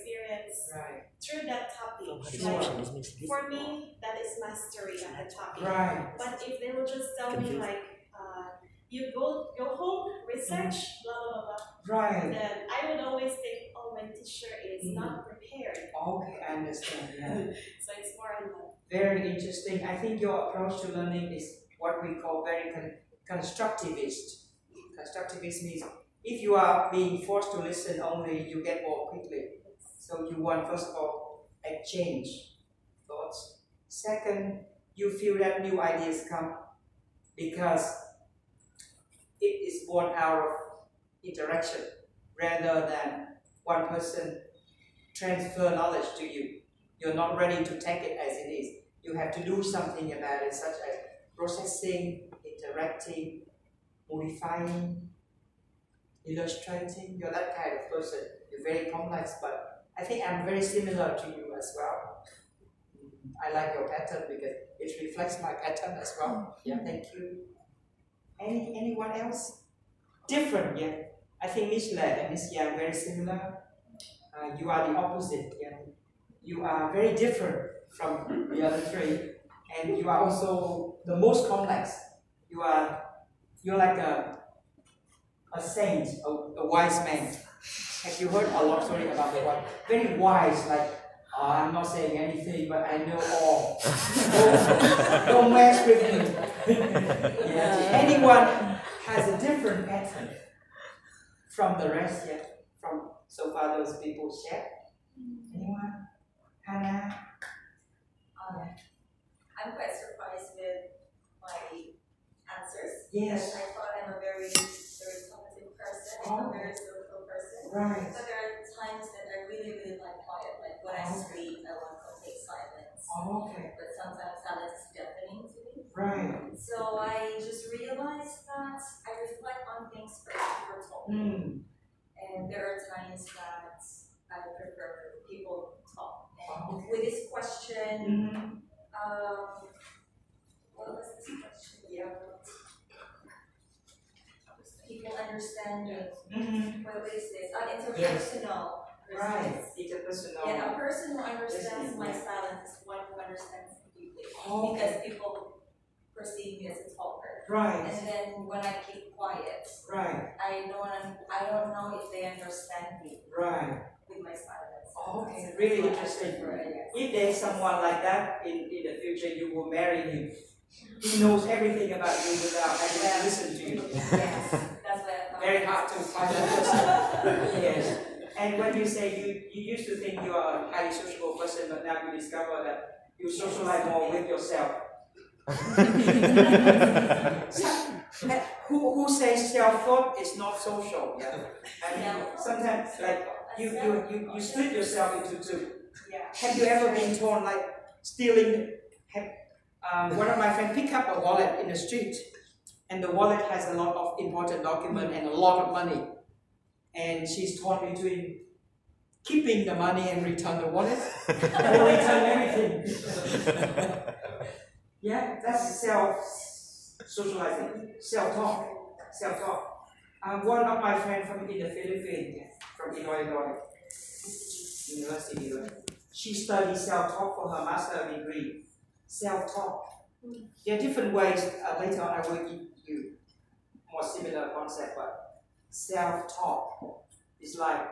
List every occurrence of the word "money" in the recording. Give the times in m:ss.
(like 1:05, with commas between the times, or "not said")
3:25, 3:29.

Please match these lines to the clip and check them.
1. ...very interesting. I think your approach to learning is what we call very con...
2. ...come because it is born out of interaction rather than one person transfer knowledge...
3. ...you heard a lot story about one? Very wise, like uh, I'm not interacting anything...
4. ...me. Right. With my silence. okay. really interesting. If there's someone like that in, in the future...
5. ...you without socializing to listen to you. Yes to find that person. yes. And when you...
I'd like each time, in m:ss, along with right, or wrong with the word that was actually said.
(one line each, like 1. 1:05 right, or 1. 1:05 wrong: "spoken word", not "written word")
1. 0:18 right
2. 0:36 right
3. 1:28 wrong: "saying", not "interacting"
4. 2:43 right
5. 2:52 wrong: "having", not "socializing".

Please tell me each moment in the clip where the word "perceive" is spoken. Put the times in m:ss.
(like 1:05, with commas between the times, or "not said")
2:36.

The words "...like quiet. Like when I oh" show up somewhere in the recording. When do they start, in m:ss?
1:59.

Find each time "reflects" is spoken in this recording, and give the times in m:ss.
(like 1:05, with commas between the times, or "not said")
1:05, 2:09.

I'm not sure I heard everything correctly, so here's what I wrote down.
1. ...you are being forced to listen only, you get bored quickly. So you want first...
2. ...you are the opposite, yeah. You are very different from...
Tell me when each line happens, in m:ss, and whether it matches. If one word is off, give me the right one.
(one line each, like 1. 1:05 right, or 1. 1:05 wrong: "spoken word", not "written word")
1. 0:26 right
2. 1:14 right.